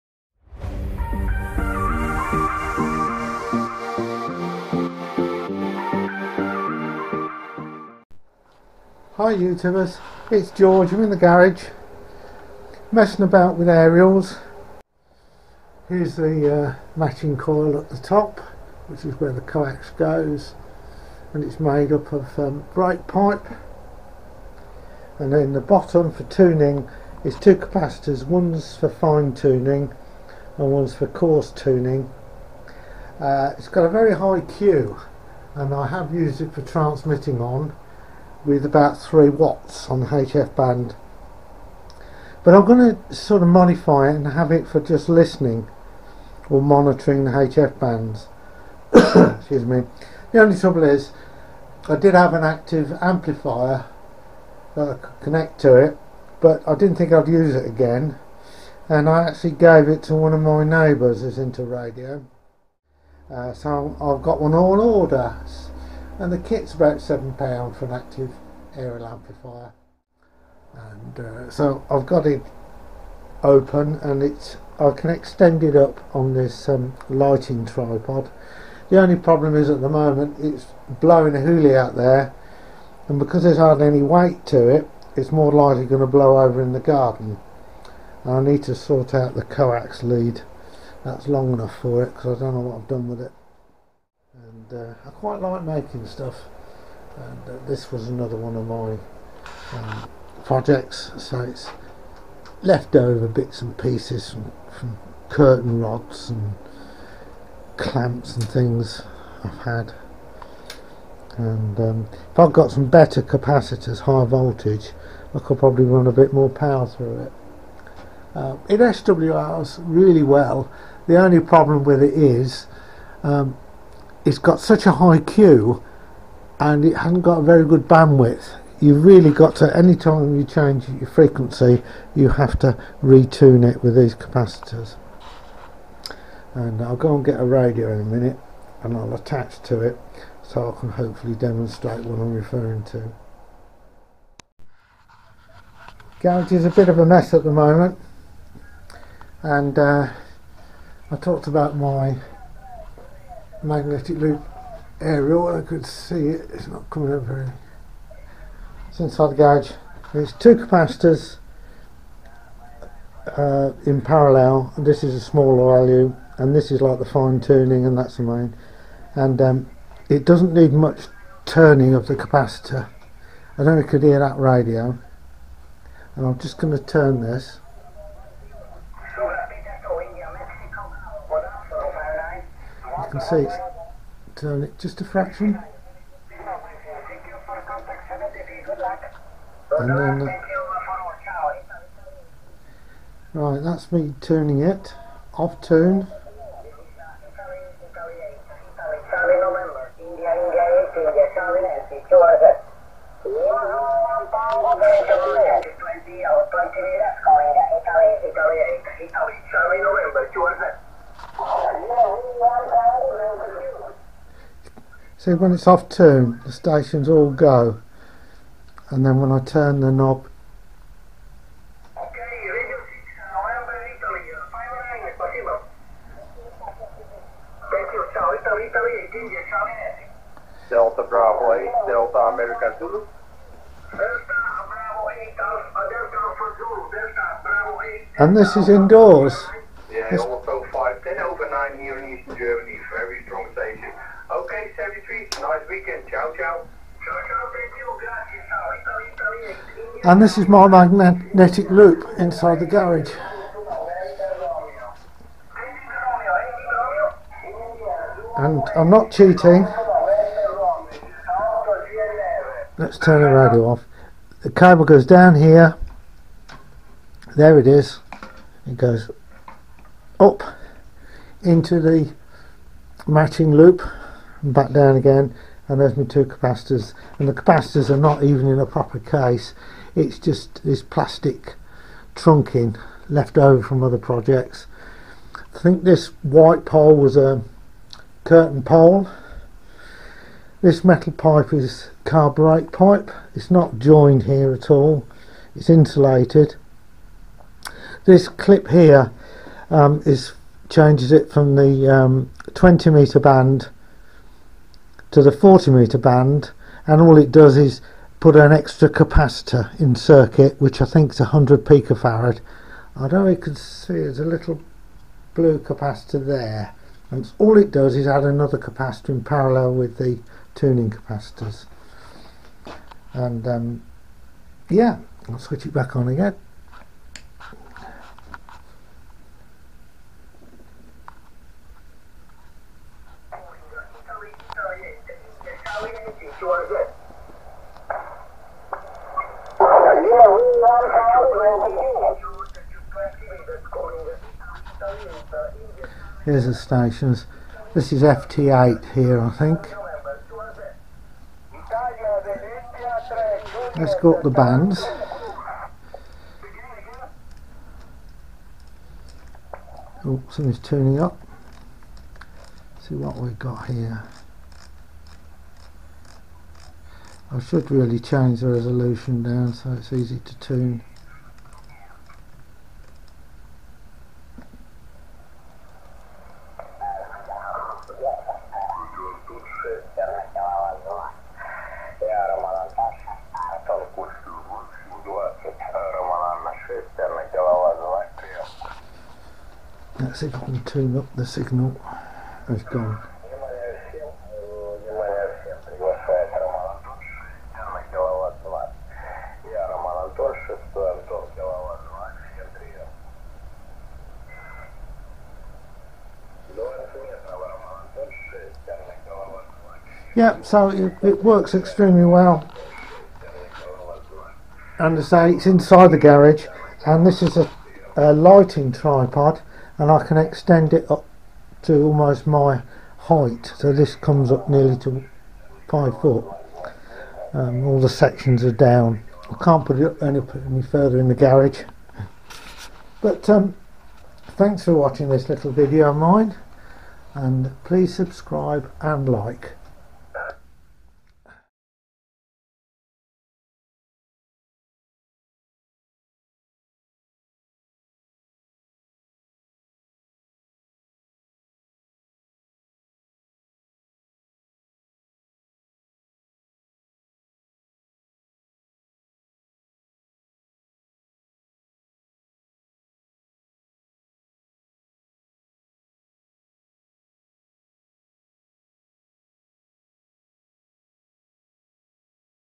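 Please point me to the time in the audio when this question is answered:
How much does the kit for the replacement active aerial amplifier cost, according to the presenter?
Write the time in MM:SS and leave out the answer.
01:06.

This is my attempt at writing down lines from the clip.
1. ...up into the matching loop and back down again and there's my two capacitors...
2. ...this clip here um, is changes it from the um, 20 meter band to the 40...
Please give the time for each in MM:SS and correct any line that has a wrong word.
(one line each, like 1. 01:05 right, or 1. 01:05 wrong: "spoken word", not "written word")
1. 04:30 right
2. 04:58 right.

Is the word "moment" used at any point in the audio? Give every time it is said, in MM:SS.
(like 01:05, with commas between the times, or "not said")
01:19, 02:27.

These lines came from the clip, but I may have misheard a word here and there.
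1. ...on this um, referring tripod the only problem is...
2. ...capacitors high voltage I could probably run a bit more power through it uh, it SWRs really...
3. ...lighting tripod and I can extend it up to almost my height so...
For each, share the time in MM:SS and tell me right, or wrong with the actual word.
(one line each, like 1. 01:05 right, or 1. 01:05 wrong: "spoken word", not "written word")
1. 01:16 wrong: "lighting", not "referring"
2. 01:53 right
3. 06:58 right.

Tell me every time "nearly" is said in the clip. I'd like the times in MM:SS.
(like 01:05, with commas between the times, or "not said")
07:04.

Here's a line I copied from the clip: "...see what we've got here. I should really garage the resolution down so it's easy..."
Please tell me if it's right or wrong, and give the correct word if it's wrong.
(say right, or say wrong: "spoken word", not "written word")
wrong: "change", not "garage".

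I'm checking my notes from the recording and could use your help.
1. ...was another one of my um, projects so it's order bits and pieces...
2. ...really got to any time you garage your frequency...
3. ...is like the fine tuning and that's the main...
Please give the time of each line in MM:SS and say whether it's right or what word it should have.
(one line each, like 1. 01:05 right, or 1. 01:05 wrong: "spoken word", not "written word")
1. 01:37 wrong: "leftover", not "order"
2. 02:09 wrong: "change", not "garage"
3. 02:46 right.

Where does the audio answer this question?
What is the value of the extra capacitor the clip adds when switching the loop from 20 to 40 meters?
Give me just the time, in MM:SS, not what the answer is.
05:11.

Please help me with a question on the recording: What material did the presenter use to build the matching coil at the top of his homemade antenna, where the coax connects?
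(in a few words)
brake pipe.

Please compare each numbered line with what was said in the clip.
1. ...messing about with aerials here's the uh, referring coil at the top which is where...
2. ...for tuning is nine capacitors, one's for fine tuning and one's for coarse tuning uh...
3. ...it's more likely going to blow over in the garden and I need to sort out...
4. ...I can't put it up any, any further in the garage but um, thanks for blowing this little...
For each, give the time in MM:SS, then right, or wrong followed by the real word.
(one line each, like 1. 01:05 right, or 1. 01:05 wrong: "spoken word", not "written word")
1. 00:12 wrong: "matching", not "referring"
2. 00:26 wrong: "two", not "nine"
3. 01:25 right
4. 07:09 wrong: "watching", not "blowing".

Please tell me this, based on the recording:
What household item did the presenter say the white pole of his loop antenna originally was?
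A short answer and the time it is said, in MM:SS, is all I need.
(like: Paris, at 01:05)
a curtain pole, at 04:48.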